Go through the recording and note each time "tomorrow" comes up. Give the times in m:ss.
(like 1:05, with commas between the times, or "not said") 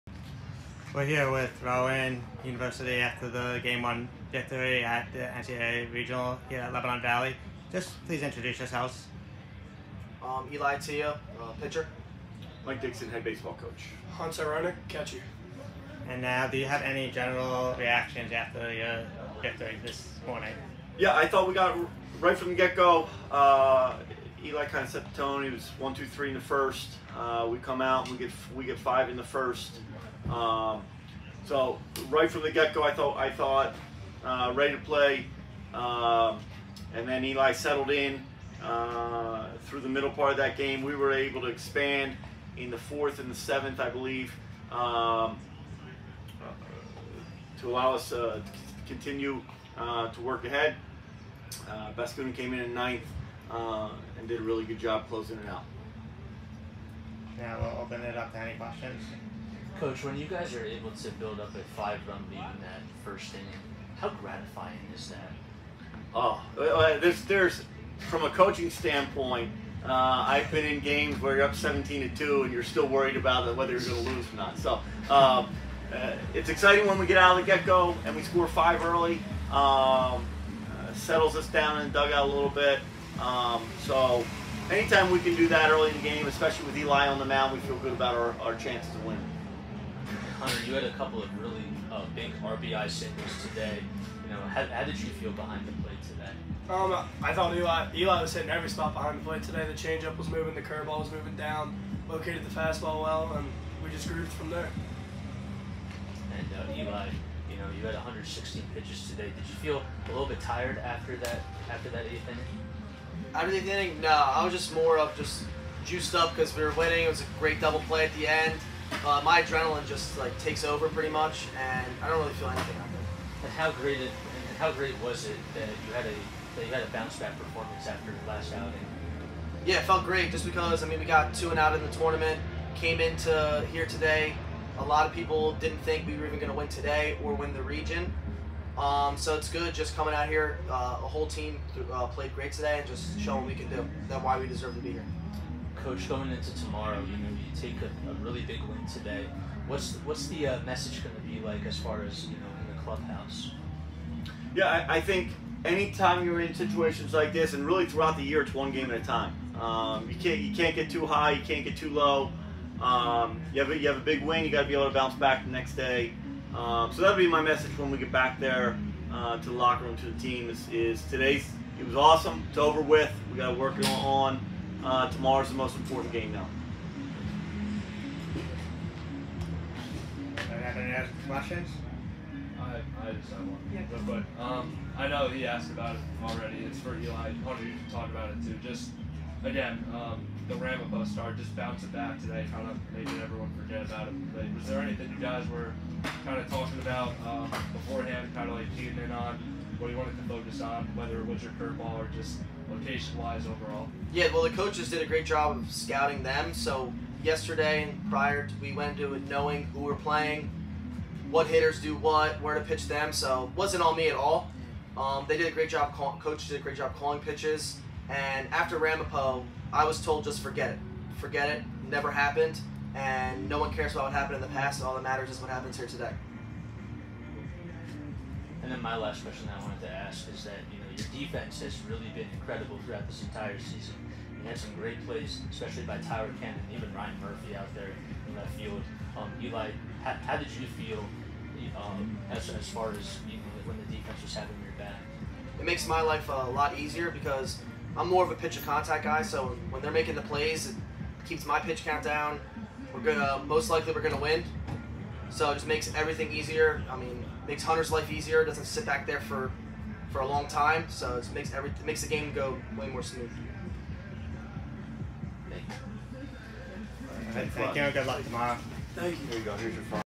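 2:26, 2:55, 4:28.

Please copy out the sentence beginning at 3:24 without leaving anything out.
Yeah, well, the coaches did a great job of scouting them.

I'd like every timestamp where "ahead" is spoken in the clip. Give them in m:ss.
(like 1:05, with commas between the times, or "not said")
0:50.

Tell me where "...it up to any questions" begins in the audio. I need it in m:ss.
0:58.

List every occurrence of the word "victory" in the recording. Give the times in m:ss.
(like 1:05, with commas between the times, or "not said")
0:04, 0:19.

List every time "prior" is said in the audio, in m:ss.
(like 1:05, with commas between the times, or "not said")
3:28.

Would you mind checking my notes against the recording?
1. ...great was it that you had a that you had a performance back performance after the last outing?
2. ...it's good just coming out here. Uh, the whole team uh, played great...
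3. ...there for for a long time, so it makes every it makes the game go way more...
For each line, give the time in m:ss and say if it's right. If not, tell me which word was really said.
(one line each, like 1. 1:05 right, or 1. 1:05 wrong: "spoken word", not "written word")
1. 2:04 wrong: "bounce", not "performance"
2. 2:19 right
3. 4:19 right.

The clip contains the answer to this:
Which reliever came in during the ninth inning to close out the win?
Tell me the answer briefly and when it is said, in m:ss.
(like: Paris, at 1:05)
Baskunin, at 0:51.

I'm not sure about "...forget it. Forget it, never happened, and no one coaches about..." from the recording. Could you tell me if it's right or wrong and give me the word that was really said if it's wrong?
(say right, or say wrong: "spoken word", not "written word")
wrong: "cares", not "coaches".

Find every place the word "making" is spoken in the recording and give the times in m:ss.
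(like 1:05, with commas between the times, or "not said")
3:12, 4:09.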